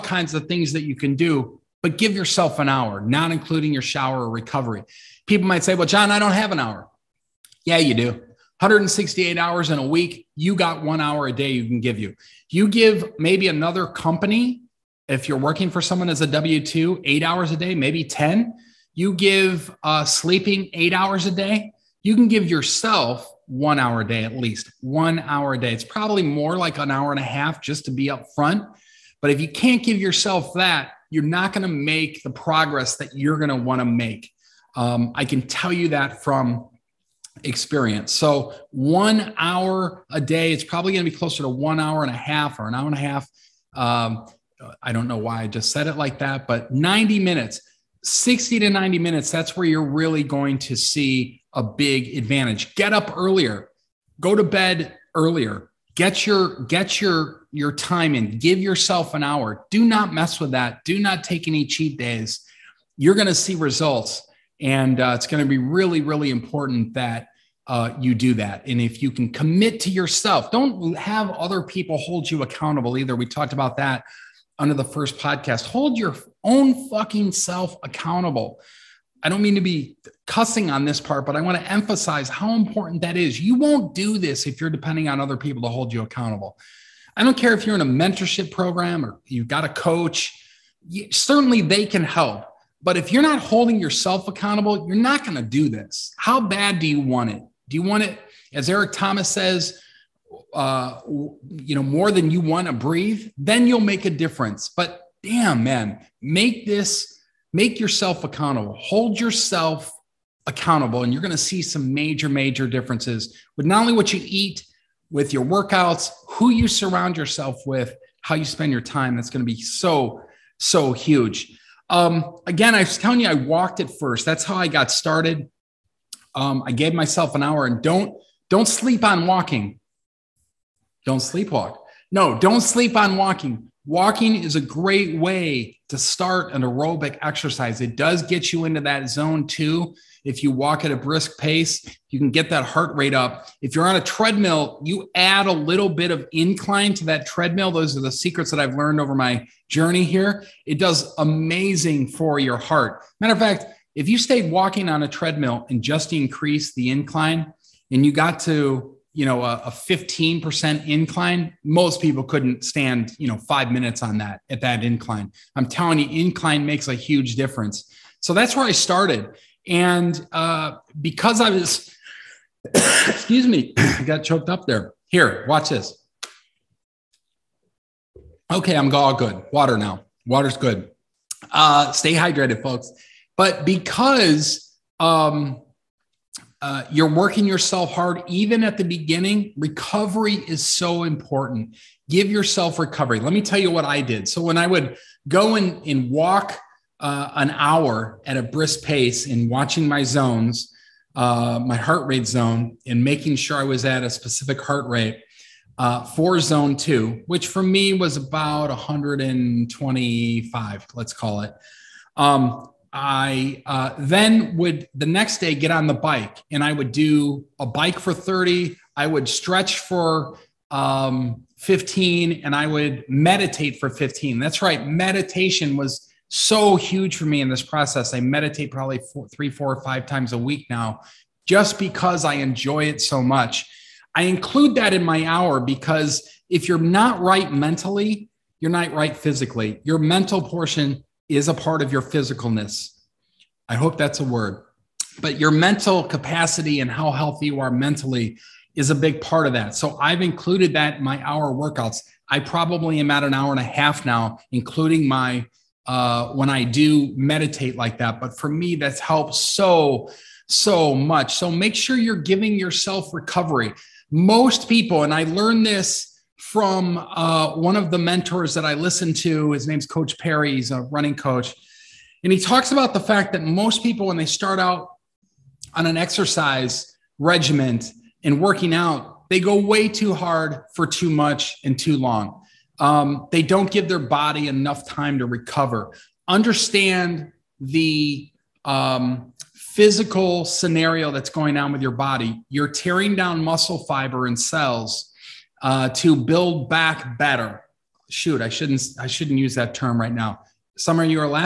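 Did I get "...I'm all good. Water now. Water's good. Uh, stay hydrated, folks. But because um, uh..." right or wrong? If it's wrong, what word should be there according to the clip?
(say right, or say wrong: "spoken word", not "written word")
right.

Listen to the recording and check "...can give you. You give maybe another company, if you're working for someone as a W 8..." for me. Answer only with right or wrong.
wrong.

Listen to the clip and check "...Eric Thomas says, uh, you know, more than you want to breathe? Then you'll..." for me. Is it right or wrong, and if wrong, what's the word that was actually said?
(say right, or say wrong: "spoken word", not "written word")
right.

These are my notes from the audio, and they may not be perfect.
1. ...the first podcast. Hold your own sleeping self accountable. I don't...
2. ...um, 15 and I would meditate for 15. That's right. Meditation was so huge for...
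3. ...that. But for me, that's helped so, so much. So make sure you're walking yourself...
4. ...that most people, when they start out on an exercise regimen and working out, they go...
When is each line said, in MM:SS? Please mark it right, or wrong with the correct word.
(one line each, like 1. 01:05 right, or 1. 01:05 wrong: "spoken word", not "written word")
1. 01:14 wrong: "fucking", not "sleeping"
2. 03:40 right
3. 04:17 wrong: "giving", not "walking"
4. 04:33 right.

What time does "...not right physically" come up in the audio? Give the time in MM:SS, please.
03:58.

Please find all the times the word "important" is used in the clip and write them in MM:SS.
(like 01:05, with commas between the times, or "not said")
01:06, 01:22, 03:11.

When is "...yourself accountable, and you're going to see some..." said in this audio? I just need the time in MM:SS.
01:49.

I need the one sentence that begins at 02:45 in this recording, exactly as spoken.
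I'm telling you, incline makes a huge difference.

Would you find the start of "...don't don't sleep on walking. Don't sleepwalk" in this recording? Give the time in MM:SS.
02:07.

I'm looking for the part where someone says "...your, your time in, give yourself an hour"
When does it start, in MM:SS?
00:57.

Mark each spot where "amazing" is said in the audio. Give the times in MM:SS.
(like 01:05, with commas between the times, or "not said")
02:31.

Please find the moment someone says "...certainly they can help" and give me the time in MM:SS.
01:31.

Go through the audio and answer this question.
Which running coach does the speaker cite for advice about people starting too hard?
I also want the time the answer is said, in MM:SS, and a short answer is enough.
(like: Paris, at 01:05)
Coach Parry, at 04:29.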